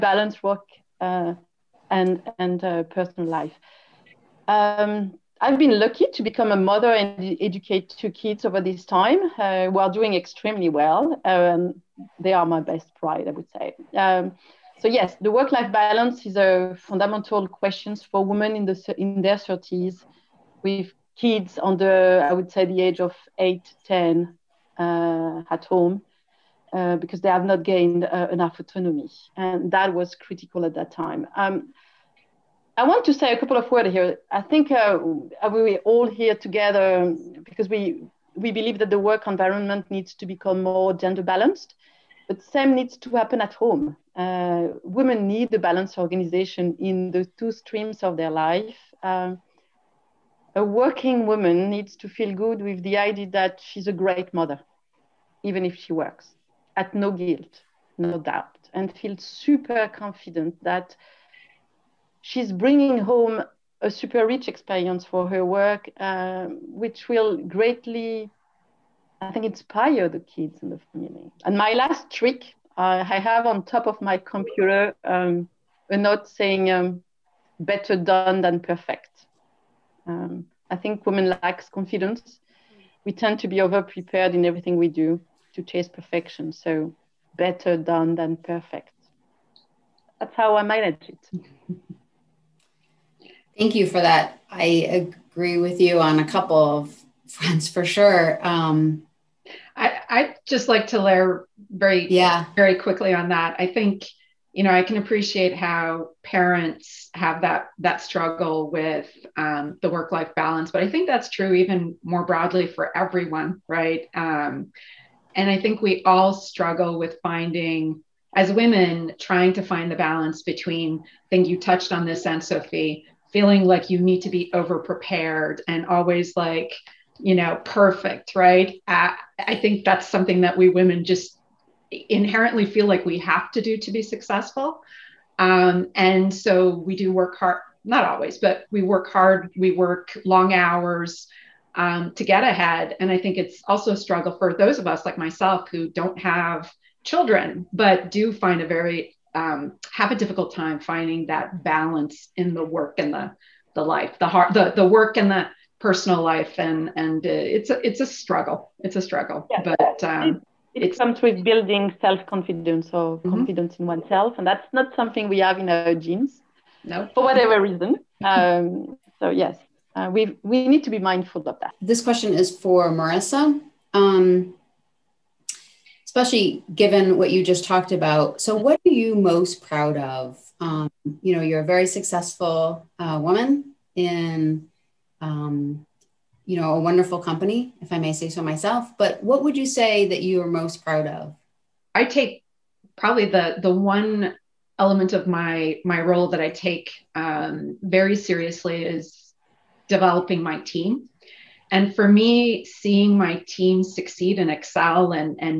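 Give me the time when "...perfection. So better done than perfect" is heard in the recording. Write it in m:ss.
1:25.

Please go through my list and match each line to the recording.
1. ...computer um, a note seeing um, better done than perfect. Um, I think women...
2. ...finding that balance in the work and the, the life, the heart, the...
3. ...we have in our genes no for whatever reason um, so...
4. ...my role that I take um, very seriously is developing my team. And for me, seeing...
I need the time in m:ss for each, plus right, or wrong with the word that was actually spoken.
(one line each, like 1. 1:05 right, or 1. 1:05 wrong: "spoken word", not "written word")
1. 1:14 wrong: "saying", not "seeing"
2. 2:30 right
3. 2:45 right
4. 3:15 right.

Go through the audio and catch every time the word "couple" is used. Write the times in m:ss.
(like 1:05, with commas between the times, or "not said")
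0:33, 1:36.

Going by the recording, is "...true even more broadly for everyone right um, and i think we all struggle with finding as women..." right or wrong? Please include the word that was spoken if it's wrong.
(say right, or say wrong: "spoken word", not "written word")
right.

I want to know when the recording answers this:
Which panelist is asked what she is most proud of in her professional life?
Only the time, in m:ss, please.
2:52.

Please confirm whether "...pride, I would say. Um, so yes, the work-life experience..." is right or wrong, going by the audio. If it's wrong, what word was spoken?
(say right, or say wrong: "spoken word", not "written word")
wrong: "balance", not "experience".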